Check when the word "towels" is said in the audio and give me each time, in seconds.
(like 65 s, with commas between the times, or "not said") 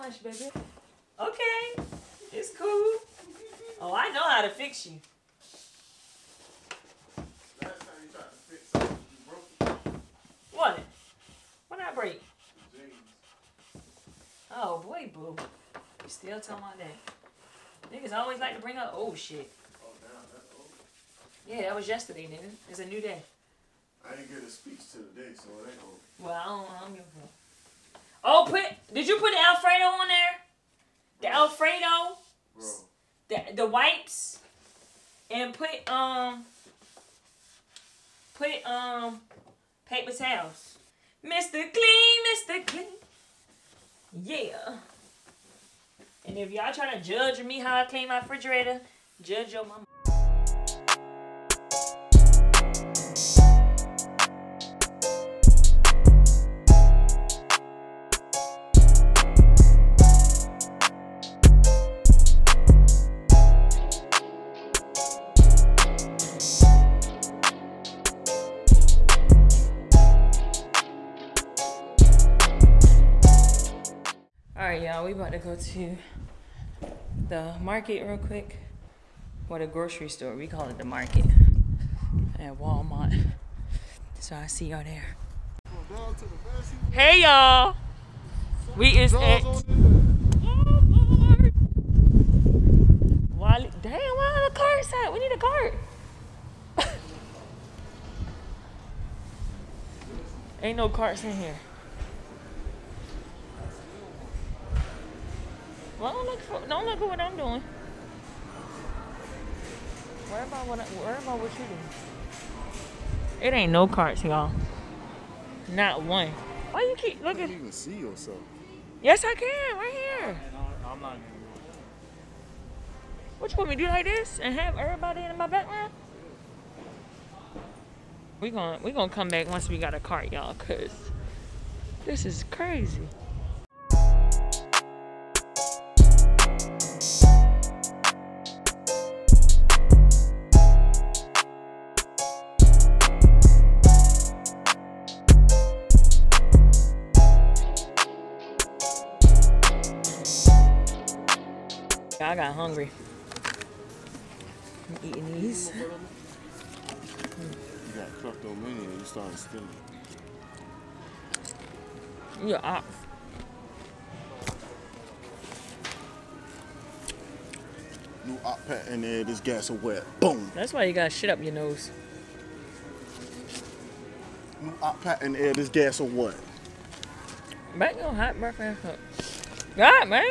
40 s.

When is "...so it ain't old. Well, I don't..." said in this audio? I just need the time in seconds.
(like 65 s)
25 s.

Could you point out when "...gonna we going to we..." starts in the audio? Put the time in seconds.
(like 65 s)
128 s.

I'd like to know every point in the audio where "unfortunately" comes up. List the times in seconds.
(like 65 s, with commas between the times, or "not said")
not said.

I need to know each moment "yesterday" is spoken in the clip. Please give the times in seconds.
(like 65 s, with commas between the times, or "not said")
21 s.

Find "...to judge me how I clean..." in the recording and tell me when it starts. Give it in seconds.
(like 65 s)
46 s.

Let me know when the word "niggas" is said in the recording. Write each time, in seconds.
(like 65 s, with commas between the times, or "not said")
17 s, 22 s.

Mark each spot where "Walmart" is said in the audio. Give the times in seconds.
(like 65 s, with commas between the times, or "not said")
82 s, 89 s.